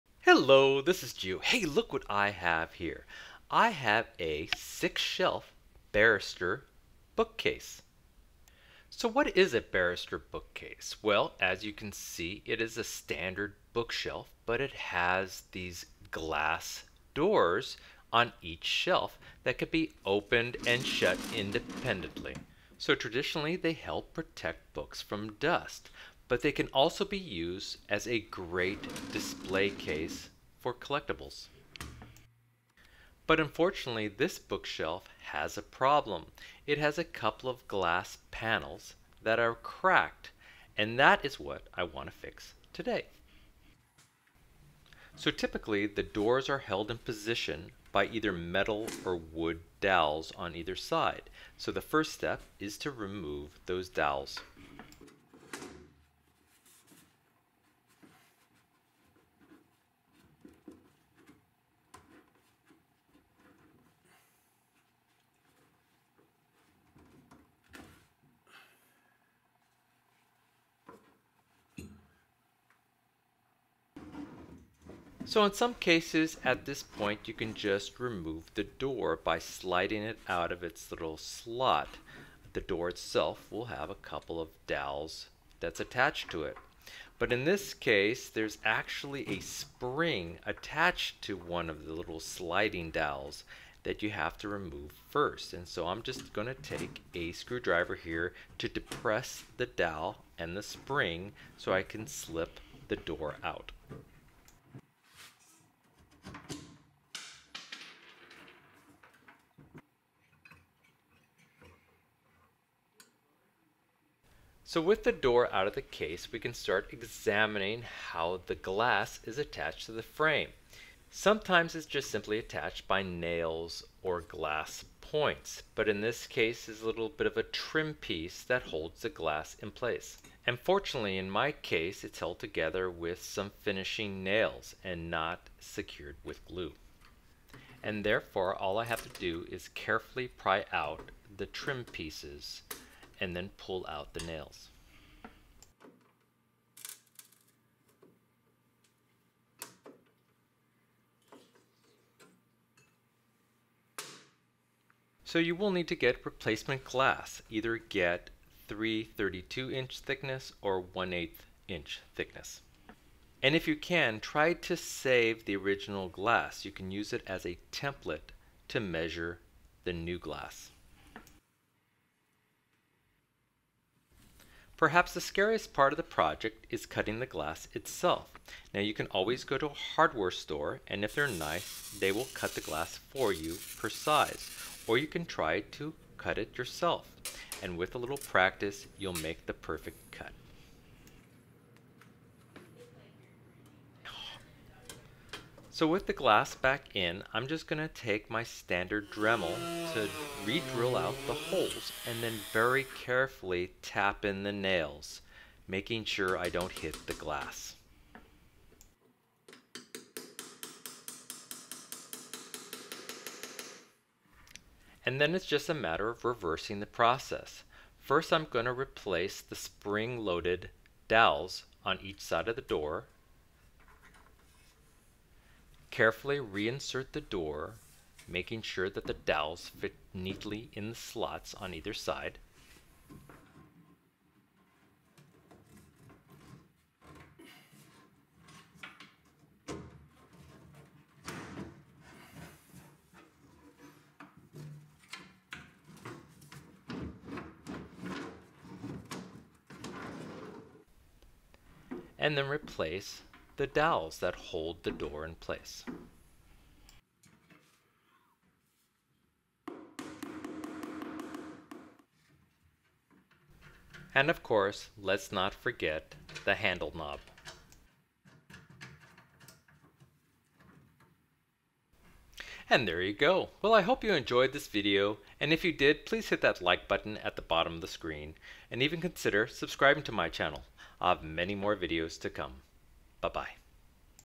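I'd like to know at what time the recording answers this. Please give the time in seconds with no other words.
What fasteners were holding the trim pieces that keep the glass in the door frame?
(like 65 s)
133 s.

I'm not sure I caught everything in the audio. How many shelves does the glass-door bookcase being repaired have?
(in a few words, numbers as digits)
6.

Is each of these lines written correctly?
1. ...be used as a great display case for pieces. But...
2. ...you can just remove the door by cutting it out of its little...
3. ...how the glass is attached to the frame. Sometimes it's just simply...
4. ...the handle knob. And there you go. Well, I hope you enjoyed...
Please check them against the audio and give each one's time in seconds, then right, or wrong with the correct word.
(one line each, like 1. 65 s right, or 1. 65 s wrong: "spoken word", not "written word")
1. 27 s wrong: "collectibles", not "pieces"
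2. 77 s wrong: "sliding", not "cutting"
3. 117 s right
4. 266 s right.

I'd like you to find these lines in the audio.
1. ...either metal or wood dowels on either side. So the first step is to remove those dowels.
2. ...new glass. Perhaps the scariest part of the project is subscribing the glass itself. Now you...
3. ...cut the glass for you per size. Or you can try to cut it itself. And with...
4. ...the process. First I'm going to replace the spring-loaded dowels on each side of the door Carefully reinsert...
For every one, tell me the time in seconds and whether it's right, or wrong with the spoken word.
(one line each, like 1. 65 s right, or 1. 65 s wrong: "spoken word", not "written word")
1. 48 s right
2. 169 s wrong: "cutting", not "subscribing"
3. 182 s wrong: "yourself", not "itself"
4. 216 s right.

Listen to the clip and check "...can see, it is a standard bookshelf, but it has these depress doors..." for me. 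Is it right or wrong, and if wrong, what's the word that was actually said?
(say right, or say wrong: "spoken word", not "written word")
wrong: "glass", not "depress".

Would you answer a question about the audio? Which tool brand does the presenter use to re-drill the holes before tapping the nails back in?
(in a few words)
Dremel.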